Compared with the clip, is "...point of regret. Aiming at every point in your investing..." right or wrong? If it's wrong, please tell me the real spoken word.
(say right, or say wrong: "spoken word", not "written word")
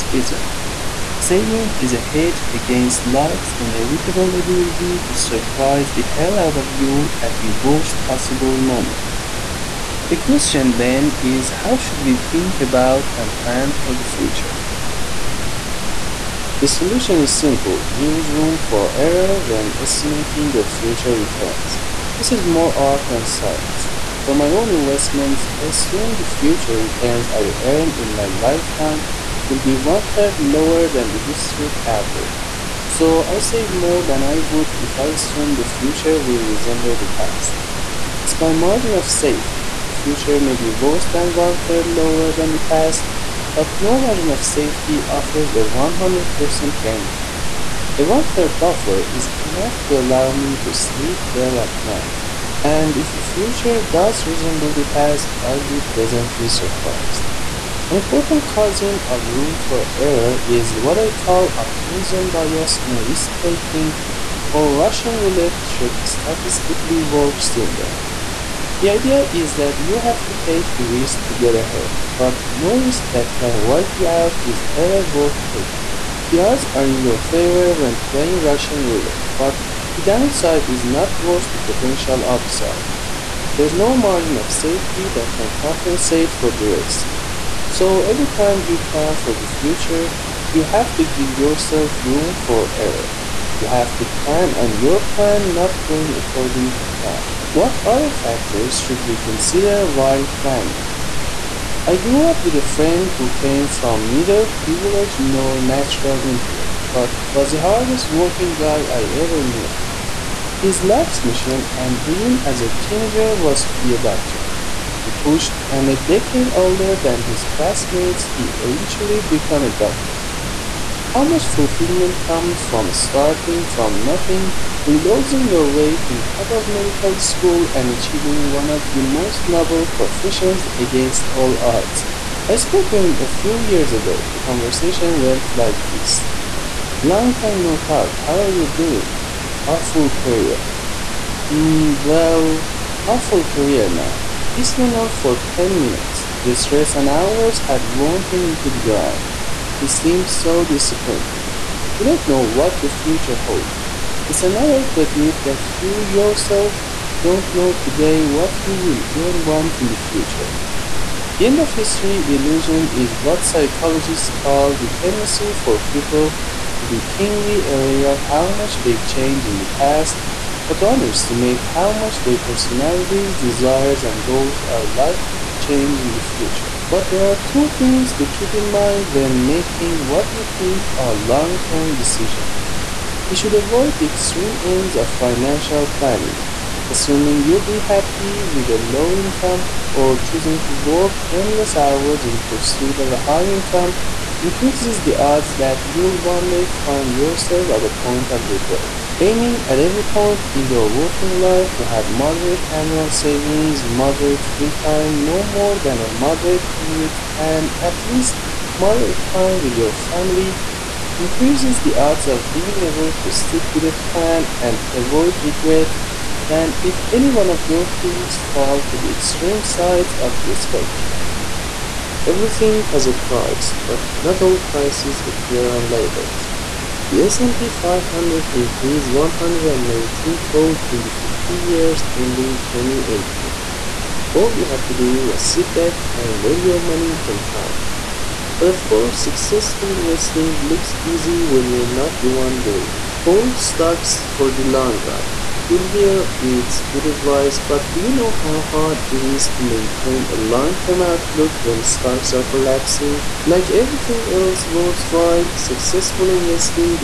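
wrong: "working", not "investing".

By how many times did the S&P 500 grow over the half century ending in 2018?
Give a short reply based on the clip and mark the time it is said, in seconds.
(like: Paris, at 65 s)
119-fold, at 229 s.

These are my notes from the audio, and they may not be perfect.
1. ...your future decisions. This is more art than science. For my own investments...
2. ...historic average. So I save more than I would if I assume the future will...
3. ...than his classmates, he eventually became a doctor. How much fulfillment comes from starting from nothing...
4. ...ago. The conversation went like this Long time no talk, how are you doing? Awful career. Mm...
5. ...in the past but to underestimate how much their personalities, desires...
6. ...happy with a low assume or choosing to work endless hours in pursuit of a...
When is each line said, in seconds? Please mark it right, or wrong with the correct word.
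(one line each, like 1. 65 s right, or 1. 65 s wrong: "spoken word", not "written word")
1. 20 s wrong: "returns", not "decisions"
2. 31 s right
3. 116 s right
4. 133 s right
5. 169 s right
6. 187 s wrong: "income", not "assume".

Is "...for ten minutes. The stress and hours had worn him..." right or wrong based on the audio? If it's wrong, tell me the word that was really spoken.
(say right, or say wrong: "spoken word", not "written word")
right.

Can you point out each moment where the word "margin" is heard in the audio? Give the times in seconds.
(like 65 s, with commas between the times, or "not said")
38 s, 44 s, 83 s.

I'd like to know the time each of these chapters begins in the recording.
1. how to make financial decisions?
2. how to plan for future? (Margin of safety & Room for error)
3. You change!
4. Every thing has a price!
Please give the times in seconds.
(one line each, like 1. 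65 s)
1. 175 s
2. 9 s
3. 96 s
4. 219 s.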